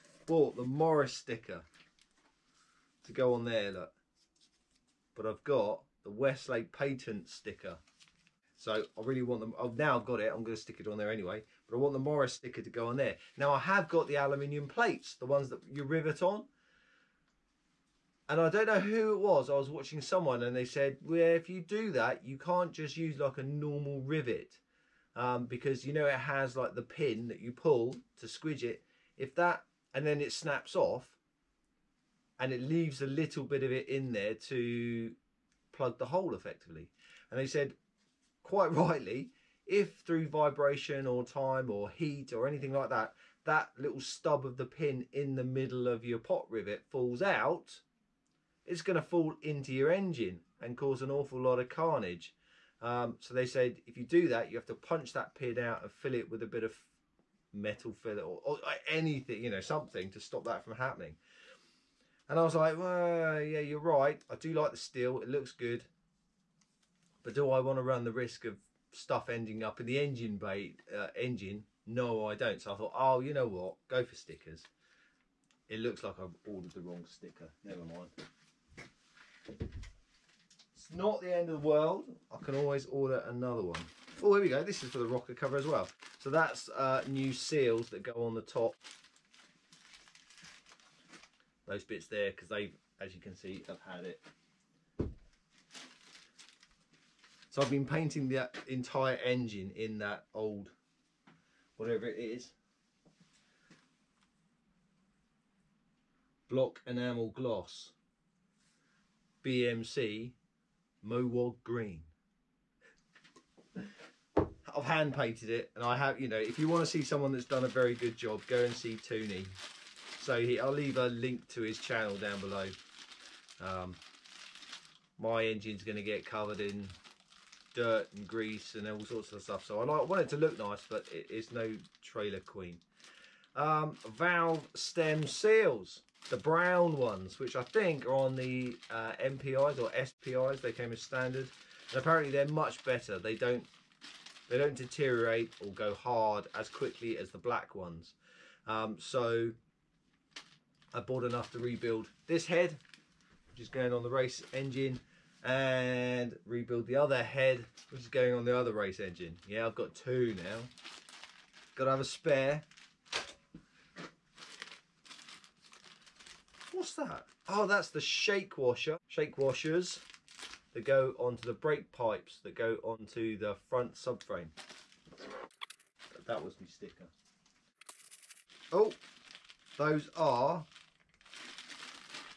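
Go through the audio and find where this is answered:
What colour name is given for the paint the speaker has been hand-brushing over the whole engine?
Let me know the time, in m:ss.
1:49.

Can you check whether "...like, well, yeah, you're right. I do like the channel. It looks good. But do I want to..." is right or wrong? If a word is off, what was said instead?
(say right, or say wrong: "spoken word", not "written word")
wrong: "steel", not "channel".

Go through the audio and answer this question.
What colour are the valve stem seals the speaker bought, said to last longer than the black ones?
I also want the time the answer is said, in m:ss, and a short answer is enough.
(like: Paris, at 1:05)
Brown, at 2:16.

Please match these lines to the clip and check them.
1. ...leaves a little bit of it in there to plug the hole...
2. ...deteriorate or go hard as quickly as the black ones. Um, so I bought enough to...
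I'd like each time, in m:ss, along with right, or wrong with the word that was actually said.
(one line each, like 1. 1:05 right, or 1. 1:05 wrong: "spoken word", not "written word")
1. 0:32 right
2. 2:24 right.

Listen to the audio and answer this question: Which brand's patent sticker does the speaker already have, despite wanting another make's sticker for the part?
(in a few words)
Weslake.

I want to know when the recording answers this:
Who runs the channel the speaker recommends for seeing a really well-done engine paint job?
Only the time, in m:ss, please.
1:58.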